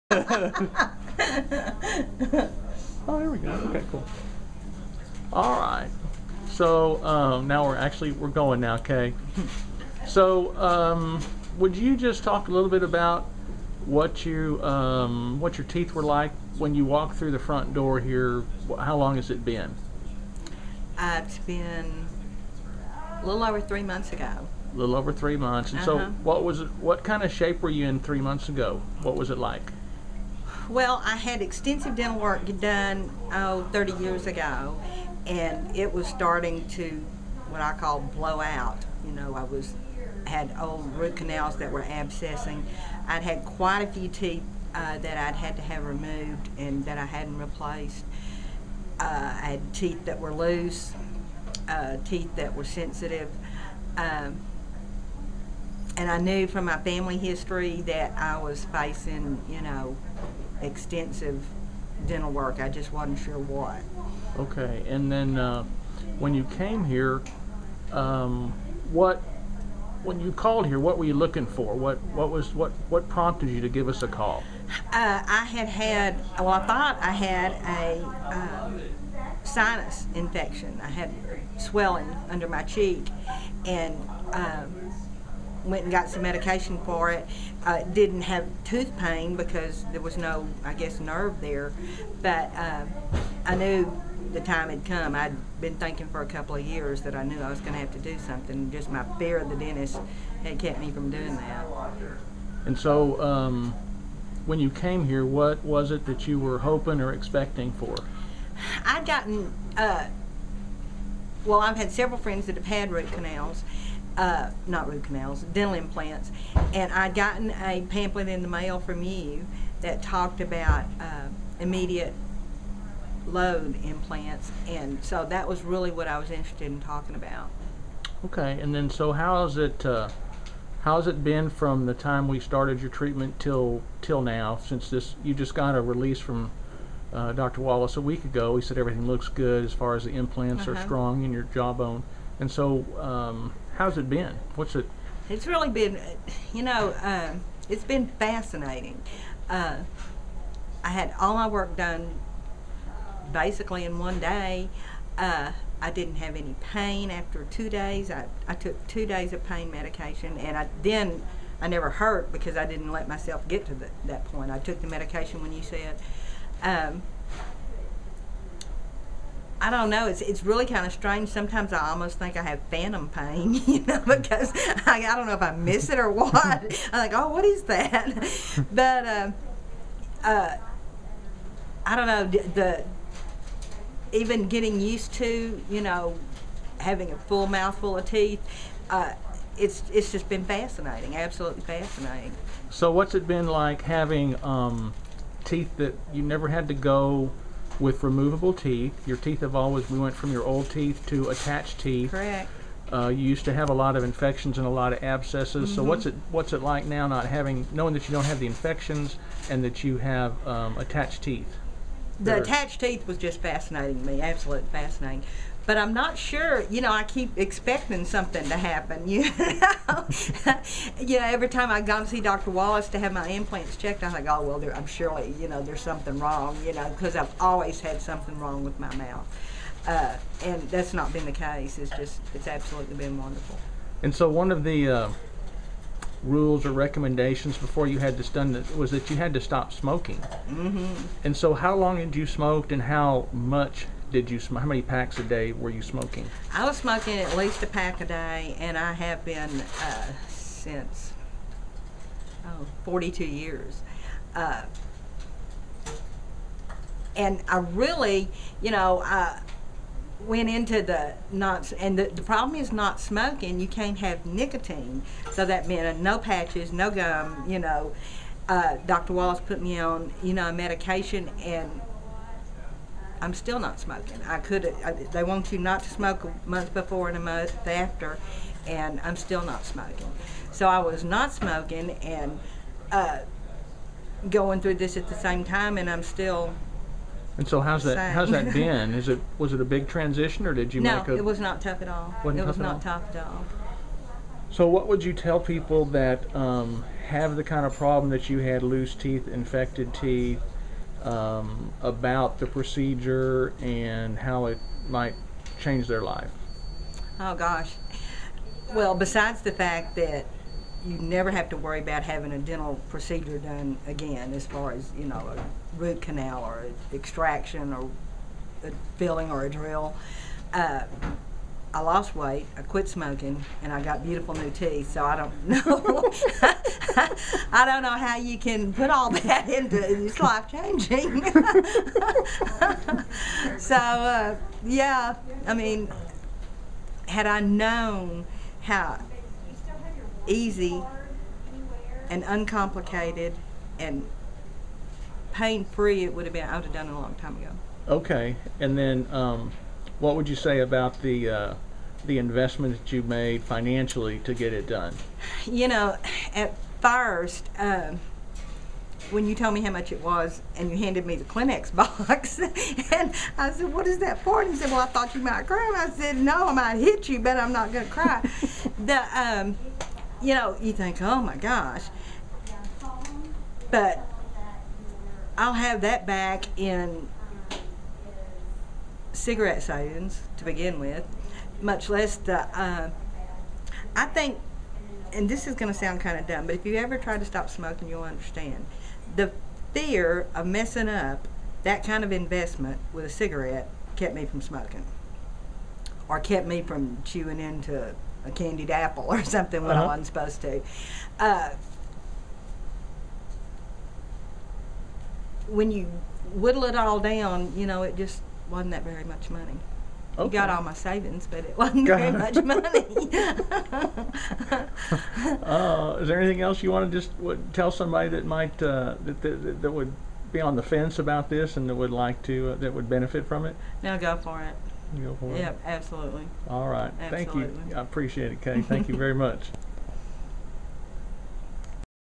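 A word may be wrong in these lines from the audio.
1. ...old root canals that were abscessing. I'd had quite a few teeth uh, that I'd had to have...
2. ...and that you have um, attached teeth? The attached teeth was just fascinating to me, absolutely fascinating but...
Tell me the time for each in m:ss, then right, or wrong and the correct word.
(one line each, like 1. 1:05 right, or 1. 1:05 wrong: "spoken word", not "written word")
1. 0:40 right
2. 3:29 right.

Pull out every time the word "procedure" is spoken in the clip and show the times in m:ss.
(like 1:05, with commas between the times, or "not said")
5:02, 5:12.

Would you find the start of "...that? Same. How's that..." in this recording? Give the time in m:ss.
4:47.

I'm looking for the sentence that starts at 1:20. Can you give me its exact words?
I had swelling under my cheek, and um, went and got some medication for it.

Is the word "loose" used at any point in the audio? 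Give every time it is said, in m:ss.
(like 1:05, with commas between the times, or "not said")
0:50, 4:58.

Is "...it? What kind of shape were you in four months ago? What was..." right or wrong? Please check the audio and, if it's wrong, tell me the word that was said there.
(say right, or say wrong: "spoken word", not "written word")
wrong: "three", not "four".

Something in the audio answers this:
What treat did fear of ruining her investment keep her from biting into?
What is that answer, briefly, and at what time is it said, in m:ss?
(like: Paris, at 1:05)
Candied apple, at 6:38.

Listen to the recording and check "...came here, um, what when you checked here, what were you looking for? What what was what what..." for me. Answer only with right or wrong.
wrong.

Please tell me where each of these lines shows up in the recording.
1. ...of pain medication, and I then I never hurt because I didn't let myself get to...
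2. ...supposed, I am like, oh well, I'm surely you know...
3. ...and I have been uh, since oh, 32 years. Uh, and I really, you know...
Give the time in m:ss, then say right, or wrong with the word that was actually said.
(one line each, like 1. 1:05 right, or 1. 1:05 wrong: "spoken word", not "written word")
1. 2:39 right
2. 3:43 wrong: "checked", not "supposed"
3. 4:08 wrong: "42", not "32".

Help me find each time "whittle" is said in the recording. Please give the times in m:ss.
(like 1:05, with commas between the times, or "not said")
6:46.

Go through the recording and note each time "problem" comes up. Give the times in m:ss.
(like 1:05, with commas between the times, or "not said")
4:22, 4:57.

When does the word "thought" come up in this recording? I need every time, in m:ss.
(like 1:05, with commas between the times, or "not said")
1:16, 6:04.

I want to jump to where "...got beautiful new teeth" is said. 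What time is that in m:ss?
5:23.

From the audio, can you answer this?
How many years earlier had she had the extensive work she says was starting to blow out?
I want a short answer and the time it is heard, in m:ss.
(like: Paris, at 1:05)
30 years, at 0:33.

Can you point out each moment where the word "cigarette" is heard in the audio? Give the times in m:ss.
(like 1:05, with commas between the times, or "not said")
6:19, 6:33.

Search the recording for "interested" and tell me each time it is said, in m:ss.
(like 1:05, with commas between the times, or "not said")
2:06.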